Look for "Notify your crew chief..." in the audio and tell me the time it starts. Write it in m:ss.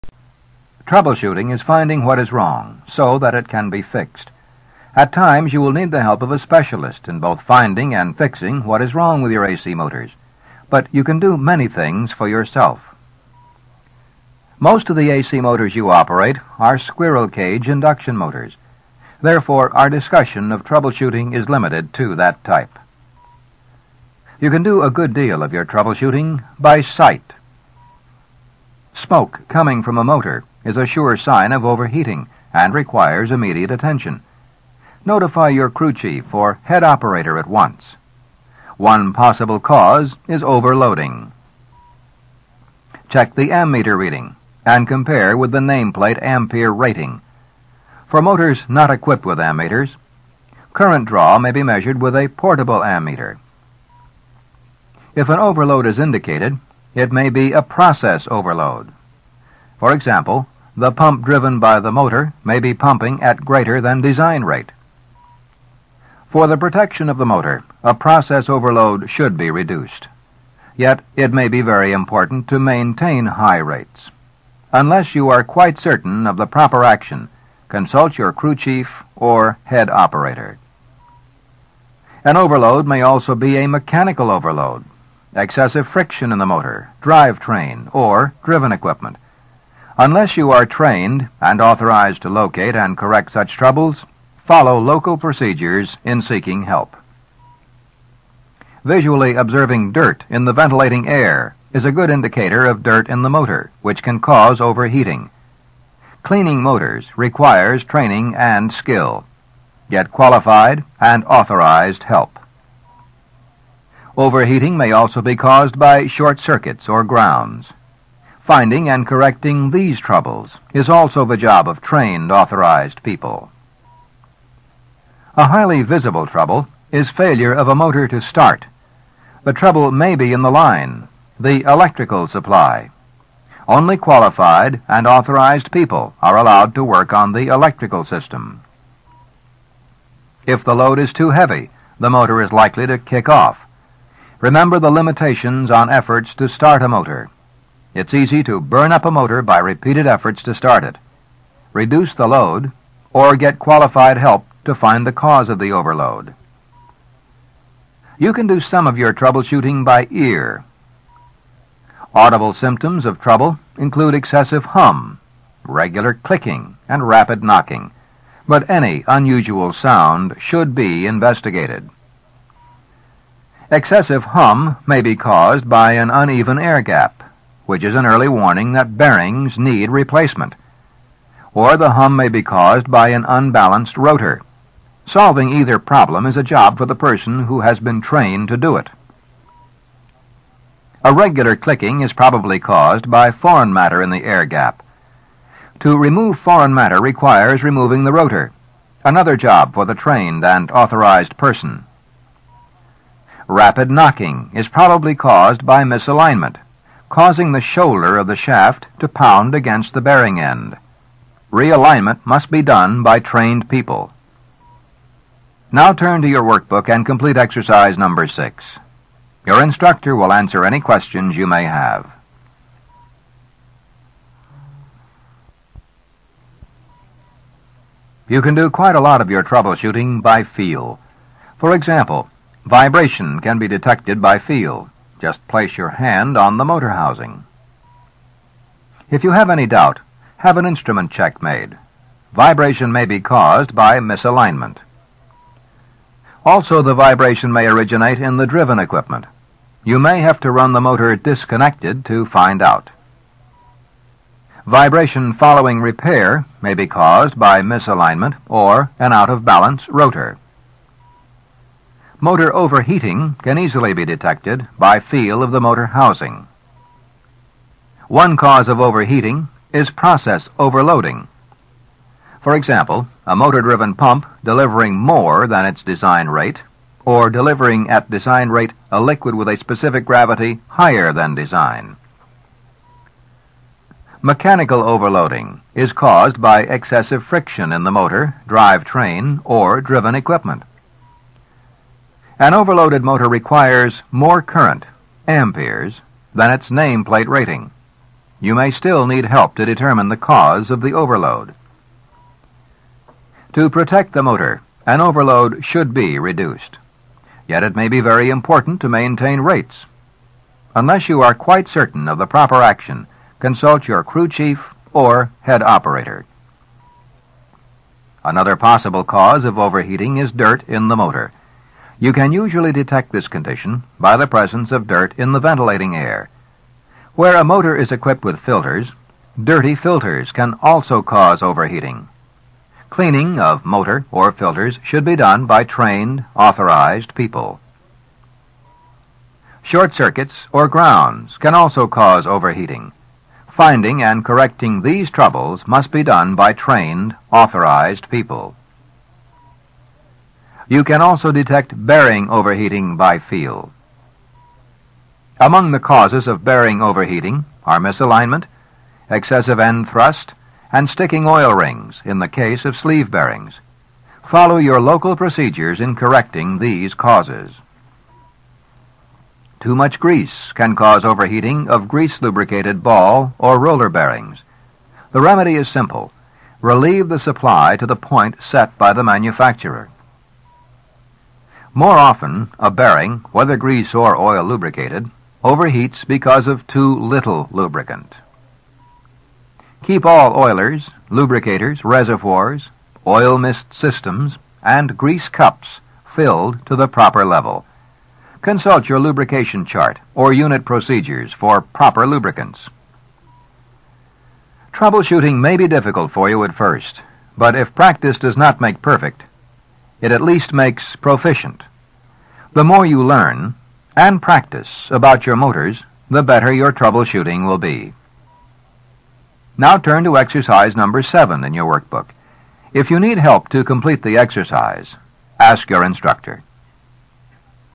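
0:35.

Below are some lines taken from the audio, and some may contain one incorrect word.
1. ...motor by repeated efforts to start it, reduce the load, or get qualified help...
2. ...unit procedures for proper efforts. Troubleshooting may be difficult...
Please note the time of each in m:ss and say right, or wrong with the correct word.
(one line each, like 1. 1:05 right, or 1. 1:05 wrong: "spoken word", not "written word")
1. 2:29 right
2. 6:40 wrong: "lubricants", not "efforts".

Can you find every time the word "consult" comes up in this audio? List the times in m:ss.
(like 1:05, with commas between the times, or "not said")
1:17, 5:13, 6:38.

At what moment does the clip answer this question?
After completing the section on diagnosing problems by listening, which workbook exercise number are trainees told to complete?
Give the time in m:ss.
3:38.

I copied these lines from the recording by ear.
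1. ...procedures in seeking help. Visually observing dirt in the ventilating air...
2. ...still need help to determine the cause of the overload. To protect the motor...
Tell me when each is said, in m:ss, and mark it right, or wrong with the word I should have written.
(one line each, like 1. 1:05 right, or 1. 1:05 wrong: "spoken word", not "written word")
1. 1:35 right
2. 4:58 right.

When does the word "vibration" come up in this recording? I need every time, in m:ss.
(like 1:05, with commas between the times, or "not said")
3:52, 4:02, 4:06, 4:14.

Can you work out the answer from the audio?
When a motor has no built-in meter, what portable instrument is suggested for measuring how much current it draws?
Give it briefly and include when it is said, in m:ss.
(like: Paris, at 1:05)
Portable ammeter, at 0:52.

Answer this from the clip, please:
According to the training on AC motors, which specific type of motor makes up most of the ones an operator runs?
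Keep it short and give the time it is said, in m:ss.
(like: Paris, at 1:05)
Squirrel cage induction motors, at 0:16.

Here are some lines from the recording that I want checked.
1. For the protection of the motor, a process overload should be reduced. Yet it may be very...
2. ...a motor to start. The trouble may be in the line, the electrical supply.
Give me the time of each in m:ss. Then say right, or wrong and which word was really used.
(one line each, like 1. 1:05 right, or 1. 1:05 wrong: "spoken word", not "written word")
1. 1:06 right
2. 2:07 right.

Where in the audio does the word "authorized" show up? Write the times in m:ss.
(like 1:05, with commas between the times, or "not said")
1:31, 1:51, 2:02, 2:15, 3:20, 5:36, 5:47.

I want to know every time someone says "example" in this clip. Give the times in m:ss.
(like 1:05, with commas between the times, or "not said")
0:59, 3:51, 4:32.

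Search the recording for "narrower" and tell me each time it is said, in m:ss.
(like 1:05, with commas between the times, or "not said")
not said.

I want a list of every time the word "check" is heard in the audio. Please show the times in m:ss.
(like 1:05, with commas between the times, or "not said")
0:43, 4:01.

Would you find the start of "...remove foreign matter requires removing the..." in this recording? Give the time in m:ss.
3:15.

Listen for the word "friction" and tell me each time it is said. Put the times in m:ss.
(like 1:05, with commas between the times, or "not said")
1:25, 4:47.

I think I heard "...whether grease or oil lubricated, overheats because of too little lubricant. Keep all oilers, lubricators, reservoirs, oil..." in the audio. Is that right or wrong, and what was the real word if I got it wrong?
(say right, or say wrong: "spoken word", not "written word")
right.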